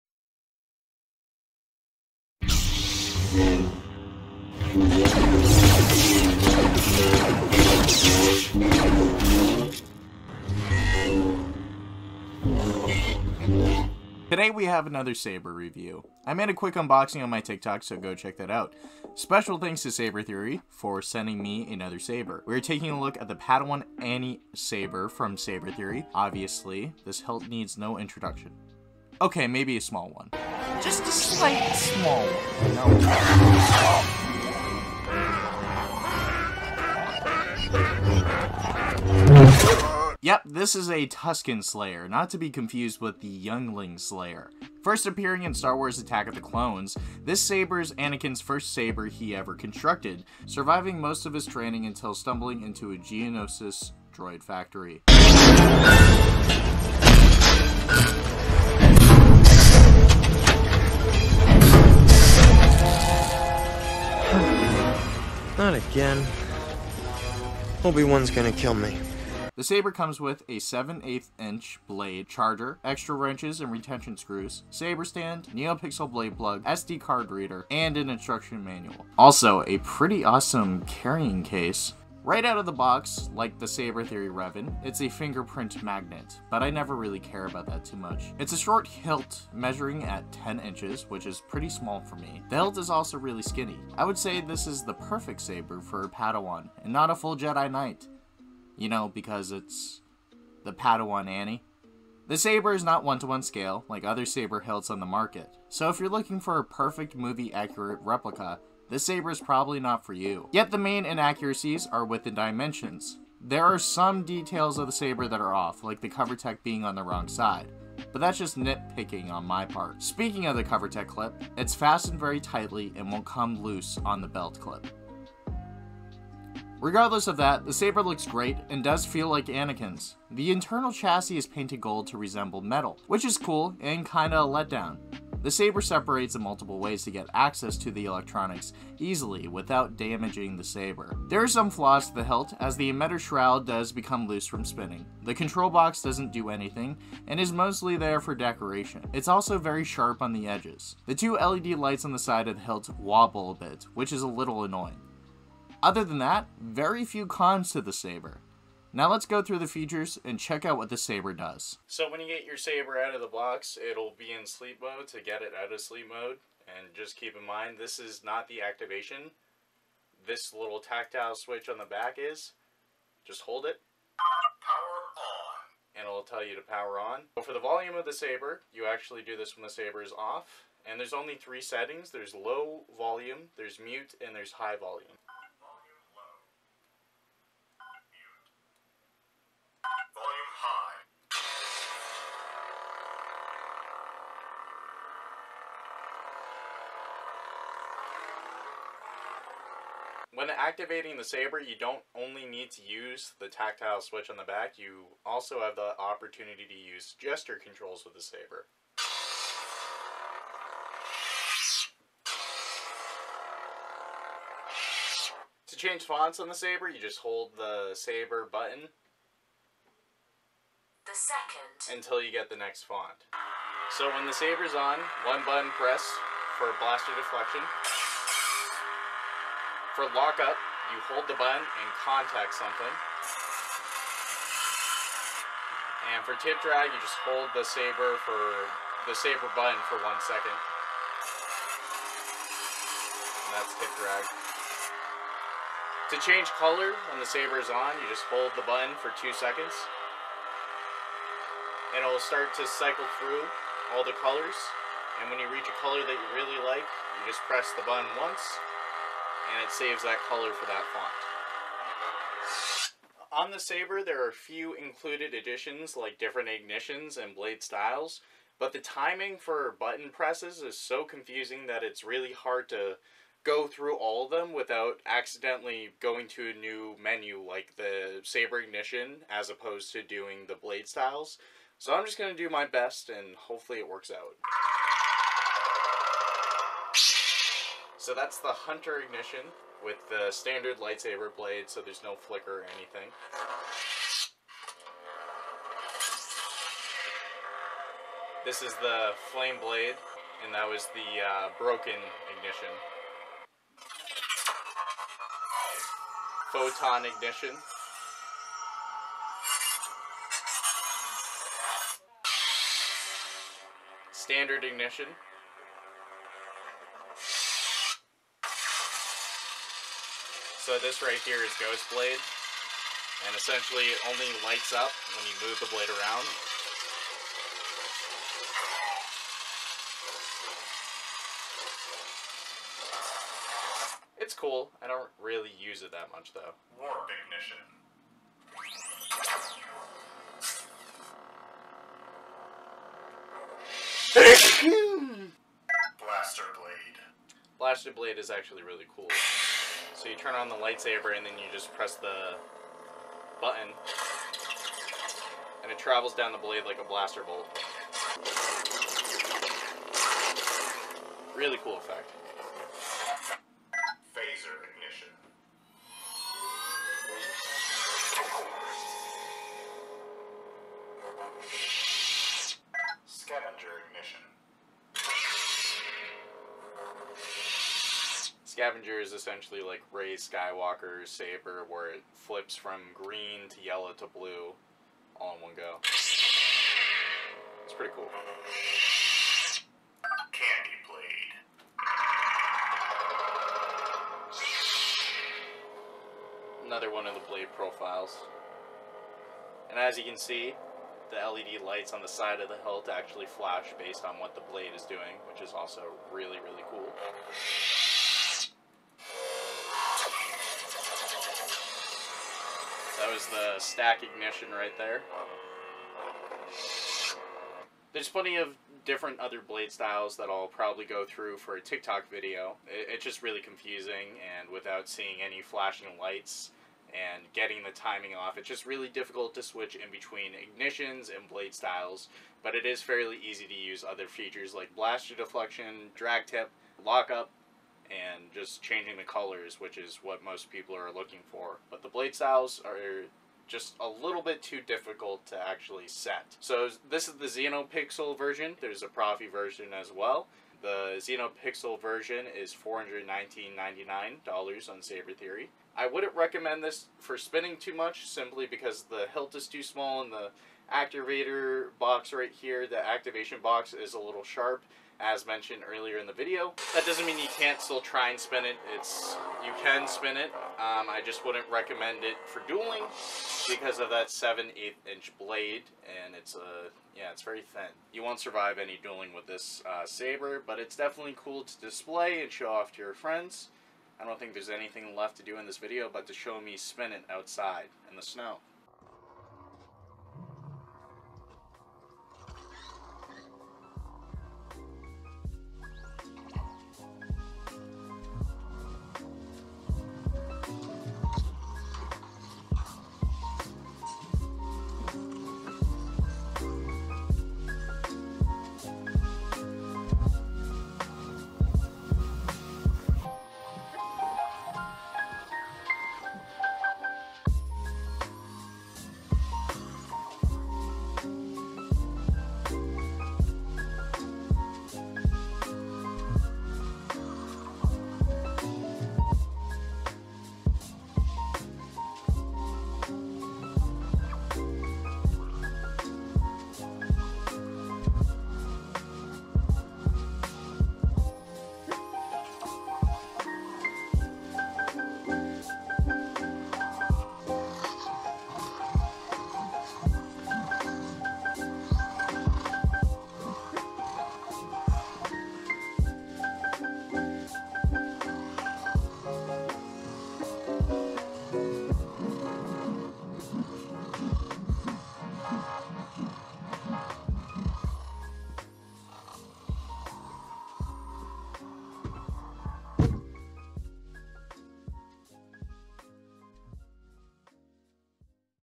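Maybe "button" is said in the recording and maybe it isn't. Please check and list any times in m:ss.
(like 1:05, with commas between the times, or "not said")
3:38, 3:45, 3:51, 3:59, 4:08, 4:17, 4:29, 5:53.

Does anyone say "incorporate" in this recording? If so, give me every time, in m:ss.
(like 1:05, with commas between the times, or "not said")
not said.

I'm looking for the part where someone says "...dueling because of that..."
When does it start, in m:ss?
7:52.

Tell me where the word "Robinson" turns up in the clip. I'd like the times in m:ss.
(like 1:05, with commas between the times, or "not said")
not said.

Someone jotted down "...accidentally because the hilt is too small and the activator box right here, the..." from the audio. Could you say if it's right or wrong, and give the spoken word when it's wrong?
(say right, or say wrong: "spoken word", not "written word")
wrong: "simply", not "accidentally".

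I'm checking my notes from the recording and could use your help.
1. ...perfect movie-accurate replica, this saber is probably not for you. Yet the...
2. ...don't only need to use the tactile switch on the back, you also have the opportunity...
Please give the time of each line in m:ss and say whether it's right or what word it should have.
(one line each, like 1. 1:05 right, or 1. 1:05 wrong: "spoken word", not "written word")
1. 1:46 right
2. 3:21 right.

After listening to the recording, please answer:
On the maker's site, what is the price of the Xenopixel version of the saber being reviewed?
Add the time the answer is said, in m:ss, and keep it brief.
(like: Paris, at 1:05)
$419.99, at 7:32.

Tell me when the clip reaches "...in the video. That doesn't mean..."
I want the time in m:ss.
7:45.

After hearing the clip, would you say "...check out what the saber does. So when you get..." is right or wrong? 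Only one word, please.
right.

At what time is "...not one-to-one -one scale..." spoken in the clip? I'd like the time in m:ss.
1:42.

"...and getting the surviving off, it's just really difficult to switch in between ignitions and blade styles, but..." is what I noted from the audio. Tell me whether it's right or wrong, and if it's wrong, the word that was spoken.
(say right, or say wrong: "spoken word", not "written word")
wrong: "timing", not "surviving".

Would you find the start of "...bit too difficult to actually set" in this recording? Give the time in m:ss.
7:24.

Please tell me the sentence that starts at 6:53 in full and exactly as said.
was the stack ignition right there.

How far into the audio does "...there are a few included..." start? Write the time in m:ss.
4:24.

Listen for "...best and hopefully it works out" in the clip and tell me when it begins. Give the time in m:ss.
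4:42.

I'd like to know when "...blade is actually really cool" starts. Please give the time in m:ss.
5:47.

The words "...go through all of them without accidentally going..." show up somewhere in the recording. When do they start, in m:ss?
4:33.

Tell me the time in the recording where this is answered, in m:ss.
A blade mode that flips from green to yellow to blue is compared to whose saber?
6:19.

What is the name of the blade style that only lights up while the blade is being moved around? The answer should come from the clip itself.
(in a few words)
Ghost Blade.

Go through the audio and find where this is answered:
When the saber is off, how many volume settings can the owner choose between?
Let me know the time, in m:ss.
3:01.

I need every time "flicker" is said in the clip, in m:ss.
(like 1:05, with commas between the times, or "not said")
4:52.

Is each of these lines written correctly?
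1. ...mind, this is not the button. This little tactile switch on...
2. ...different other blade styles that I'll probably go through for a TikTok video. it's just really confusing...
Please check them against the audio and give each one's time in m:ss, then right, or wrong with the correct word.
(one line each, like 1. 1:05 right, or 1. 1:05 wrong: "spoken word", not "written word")
1. 2:47 wrong: "activation", not "button"
2. 6:58 right.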